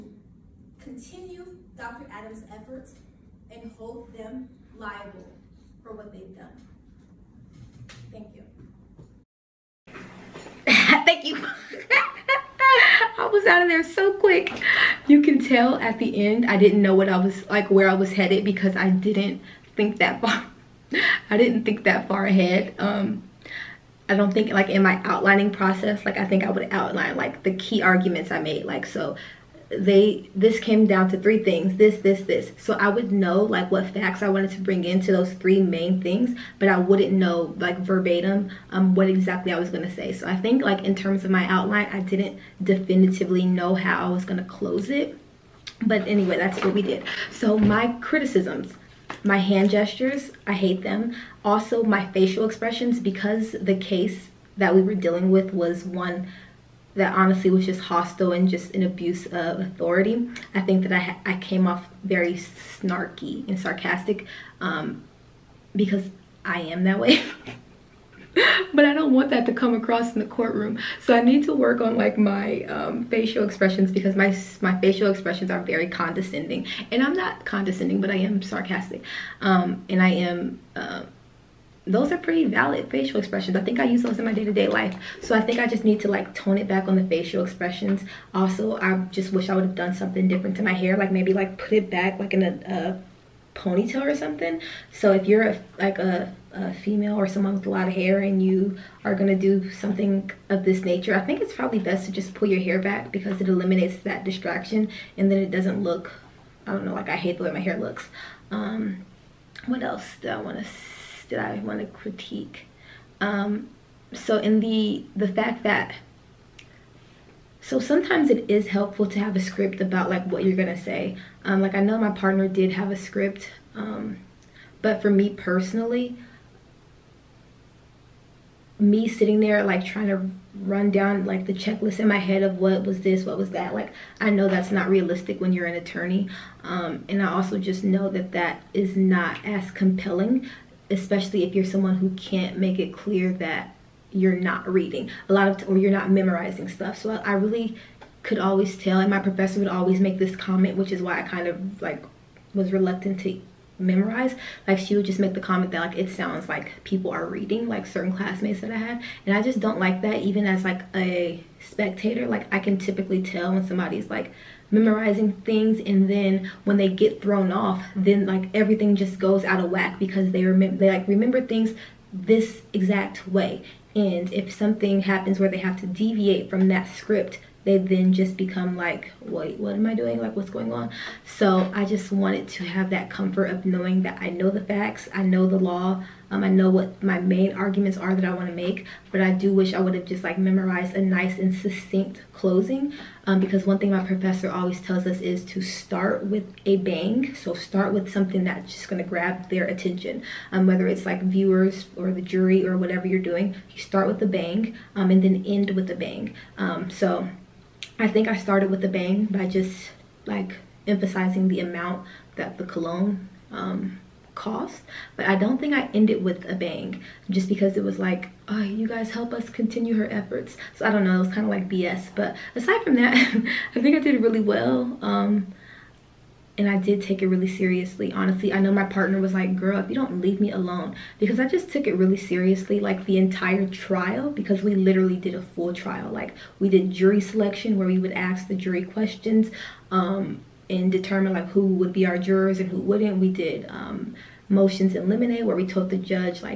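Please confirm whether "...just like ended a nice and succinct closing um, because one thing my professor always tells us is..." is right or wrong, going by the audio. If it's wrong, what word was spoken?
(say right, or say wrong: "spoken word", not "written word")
wrong: "memorized", not "ended".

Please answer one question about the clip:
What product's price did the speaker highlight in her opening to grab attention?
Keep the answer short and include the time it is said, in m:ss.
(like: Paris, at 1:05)
Cologne, at 3:32.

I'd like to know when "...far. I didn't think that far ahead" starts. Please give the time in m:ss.
0:20.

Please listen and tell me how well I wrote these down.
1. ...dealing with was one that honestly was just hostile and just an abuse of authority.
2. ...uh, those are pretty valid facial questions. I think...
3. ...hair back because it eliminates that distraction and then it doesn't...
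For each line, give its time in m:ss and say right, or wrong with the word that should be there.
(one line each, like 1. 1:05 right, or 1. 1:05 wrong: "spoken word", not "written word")
1. 0:54 right
2. 1:20 wrong: "expressions", not "questions"
3. 1:42 right.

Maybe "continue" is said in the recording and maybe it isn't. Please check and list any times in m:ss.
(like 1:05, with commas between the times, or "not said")
0:00, 3:39.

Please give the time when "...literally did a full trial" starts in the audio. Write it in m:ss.
3:54.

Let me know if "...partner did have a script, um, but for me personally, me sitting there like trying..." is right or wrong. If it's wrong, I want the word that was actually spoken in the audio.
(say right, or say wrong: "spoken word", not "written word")
right.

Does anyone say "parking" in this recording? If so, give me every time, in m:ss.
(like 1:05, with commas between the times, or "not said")
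not said.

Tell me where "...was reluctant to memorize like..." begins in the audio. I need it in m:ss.
2:32.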